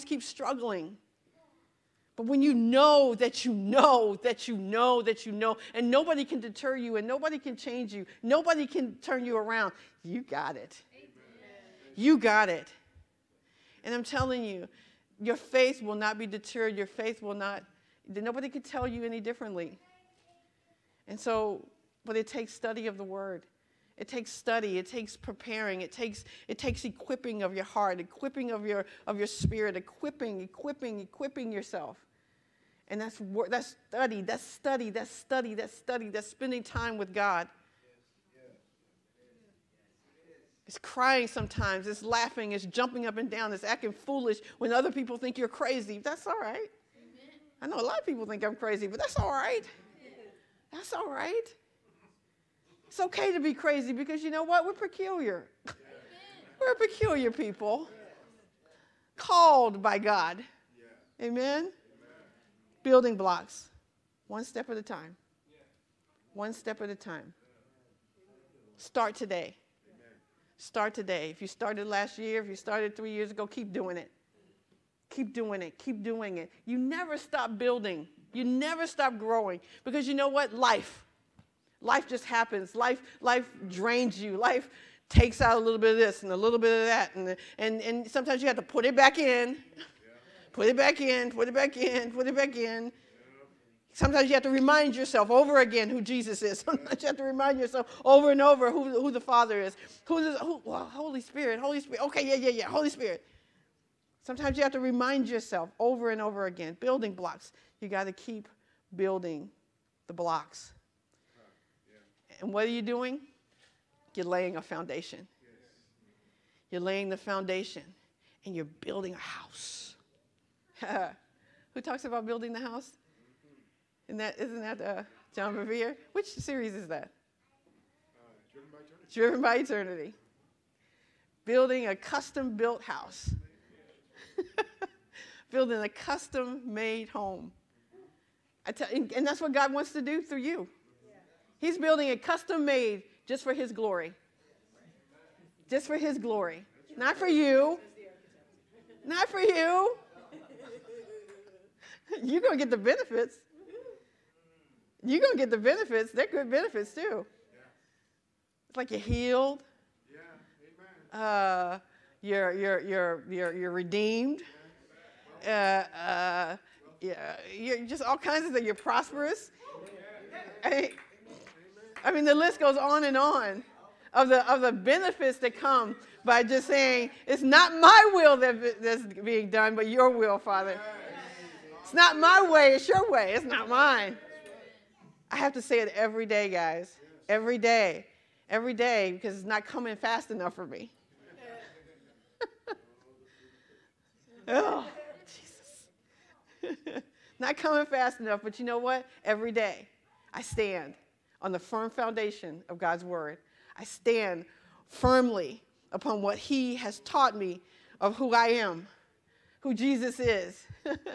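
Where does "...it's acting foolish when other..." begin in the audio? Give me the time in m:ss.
0:43.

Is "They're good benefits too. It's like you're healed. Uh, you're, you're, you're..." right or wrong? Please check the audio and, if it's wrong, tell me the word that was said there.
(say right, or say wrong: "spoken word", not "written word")
right.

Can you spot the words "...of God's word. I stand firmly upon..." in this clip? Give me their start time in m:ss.
3:22.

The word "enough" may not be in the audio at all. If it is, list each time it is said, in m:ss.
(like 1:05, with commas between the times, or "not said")
3:10, 3:18.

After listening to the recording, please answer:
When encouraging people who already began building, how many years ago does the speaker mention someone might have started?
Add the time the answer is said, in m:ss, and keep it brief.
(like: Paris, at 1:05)
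3, at 1:12.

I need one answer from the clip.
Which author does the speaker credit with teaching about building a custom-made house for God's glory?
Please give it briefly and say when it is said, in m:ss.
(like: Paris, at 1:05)
John Bevere, at 2:05.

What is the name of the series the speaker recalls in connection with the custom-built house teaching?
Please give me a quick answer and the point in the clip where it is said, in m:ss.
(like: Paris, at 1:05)
Driven by Eternity, at 2:09.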